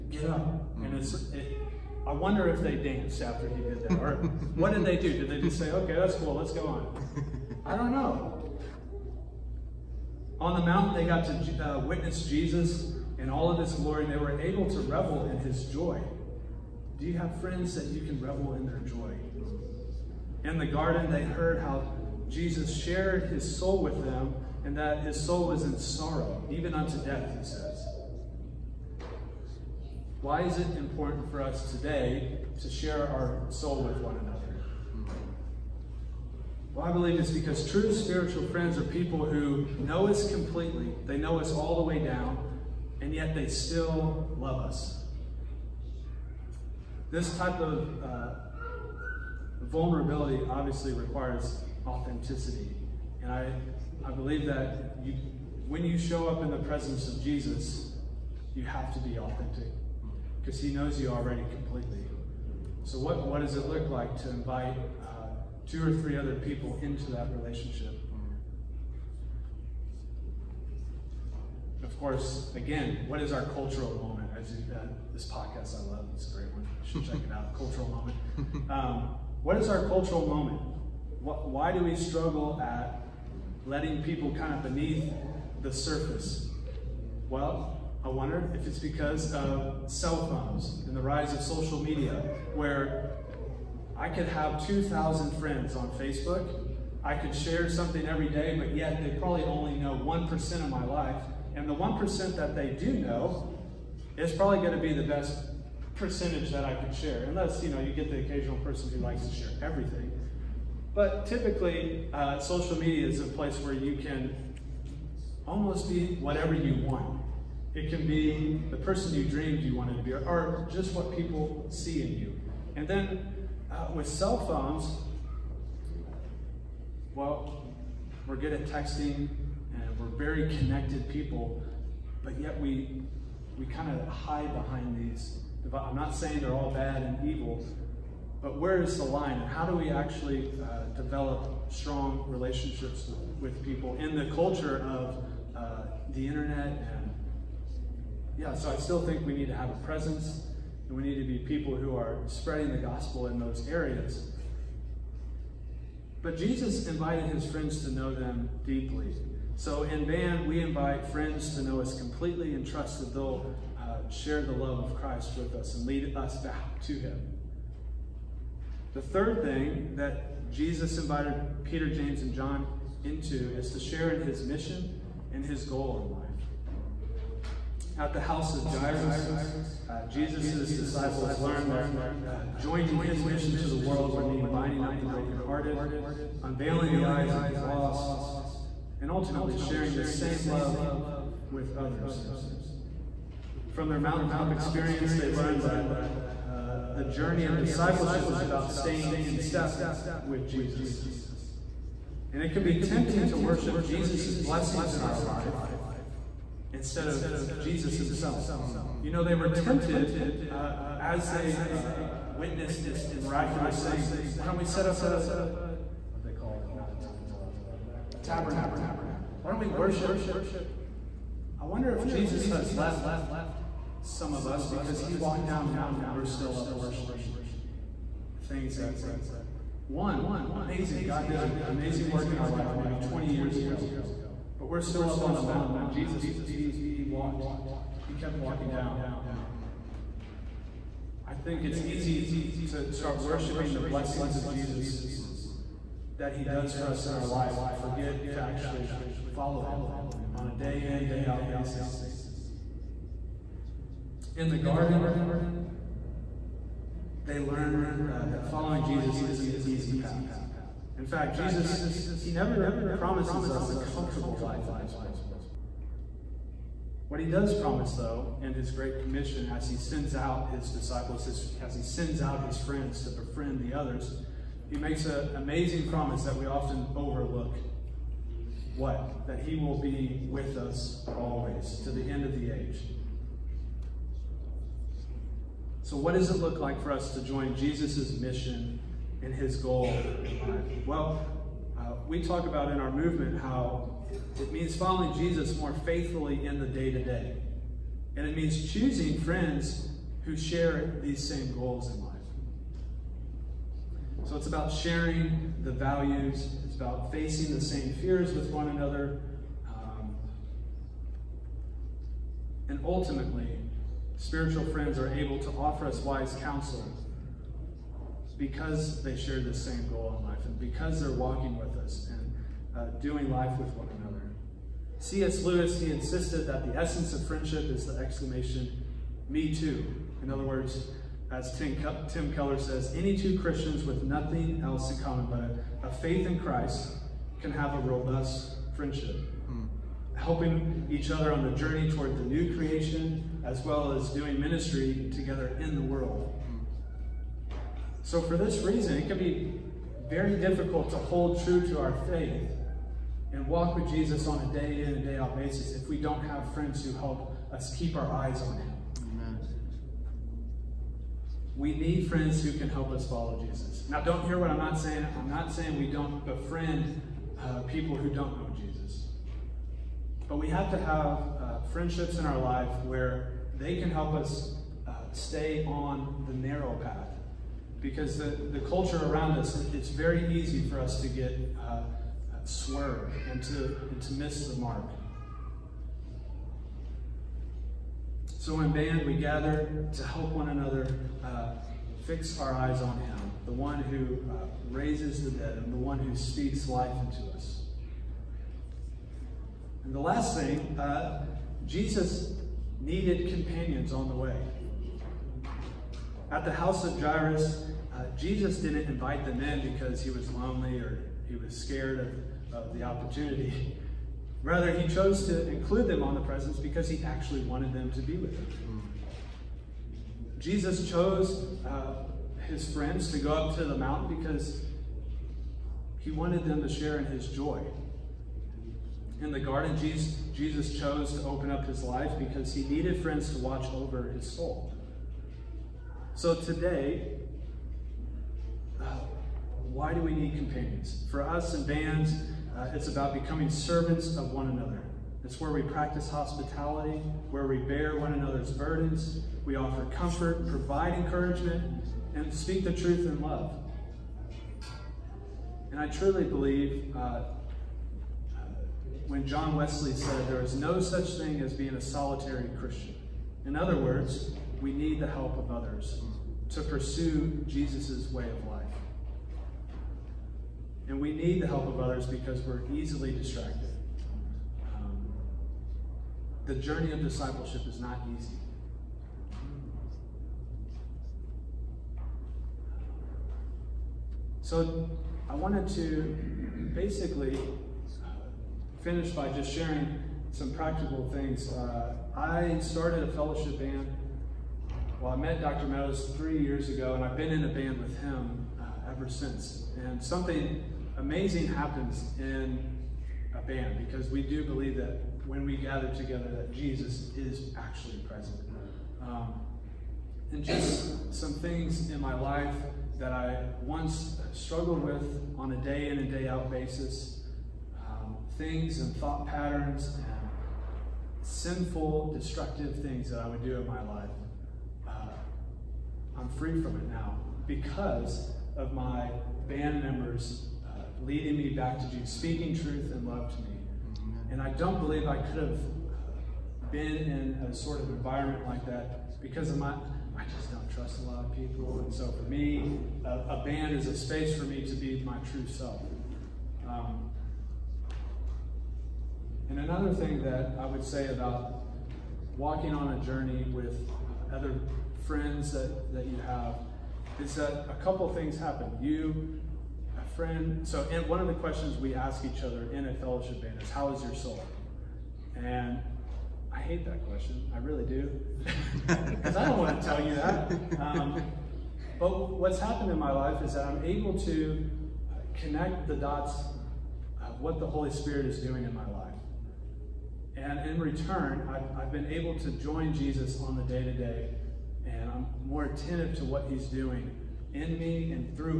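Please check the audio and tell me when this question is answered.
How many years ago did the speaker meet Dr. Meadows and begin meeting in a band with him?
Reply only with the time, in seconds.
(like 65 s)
496 s.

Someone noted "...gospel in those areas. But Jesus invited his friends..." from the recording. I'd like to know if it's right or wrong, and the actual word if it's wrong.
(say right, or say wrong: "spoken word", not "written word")
right.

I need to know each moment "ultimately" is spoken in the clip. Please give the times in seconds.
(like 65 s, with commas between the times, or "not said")
189 s, 312 s.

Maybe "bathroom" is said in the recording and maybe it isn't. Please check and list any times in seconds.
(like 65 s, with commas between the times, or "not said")
not said.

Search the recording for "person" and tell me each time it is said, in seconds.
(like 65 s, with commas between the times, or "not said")
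108 s, 118 s.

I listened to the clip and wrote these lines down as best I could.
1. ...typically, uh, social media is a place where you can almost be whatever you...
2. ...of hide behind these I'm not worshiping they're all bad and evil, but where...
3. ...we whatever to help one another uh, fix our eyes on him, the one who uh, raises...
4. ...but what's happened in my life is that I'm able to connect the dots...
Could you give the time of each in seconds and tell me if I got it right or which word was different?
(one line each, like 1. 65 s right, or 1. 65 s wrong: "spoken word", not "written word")
1. 111 s right
2. 133 s wrong: "saying", not "worshiping"
3. 389 s wrong: "gather", not "whatever"
4. 571 s right.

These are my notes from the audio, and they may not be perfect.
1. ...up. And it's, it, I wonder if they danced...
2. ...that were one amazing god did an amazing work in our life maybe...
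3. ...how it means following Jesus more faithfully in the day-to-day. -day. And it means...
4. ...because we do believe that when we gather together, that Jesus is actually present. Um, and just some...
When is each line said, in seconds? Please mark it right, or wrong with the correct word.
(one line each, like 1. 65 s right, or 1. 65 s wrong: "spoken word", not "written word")
1. 0 s right
2. 228 s right
3. 293 s right
4. 503 s right.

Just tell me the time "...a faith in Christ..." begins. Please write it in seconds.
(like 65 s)
335 s.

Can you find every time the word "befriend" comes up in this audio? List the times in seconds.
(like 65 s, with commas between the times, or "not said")
273 s, 366 s.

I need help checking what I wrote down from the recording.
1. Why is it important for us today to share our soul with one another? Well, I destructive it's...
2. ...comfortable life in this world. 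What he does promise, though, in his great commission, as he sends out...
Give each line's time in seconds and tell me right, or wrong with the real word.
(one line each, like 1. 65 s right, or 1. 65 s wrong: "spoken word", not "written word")
1. 30 s wrong: "believe", not "destructive"
2. 263 s right.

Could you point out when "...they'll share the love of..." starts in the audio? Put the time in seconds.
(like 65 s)
163 s.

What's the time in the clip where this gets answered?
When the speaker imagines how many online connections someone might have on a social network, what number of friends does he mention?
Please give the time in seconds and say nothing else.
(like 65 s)
94 s.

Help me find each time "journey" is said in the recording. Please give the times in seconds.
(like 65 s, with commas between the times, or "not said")
197 s, 341 s, 476 s, 553 s.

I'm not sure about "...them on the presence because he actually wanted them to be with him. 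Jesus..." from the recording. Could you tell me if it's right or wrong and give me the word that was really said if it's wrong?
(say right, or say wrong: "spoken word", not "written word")
right.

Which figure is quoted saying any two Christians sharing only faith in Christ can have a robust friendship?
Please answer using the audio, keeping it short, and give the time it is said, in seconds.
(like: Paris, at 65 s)
Tim Keller, at 332 s.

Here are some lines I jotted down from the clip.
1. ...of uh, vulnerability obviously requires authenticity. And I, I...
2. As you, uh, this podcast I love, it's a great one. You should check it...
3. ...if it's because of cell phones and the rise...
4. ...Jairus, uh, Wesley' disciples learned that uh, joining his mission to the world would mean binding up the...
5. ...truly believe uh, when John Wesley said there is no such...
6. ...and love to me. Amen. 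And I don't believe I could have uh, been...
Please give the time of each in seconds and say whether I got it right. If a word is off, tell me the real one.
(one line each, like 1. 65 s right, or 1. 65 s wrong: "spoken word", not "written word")
1. 47 s right
2. 74 s right
3. 88 s right
4. 178 s wrong: "Jesus", not "Wesley"
5. 455 s right
6. 532 s right.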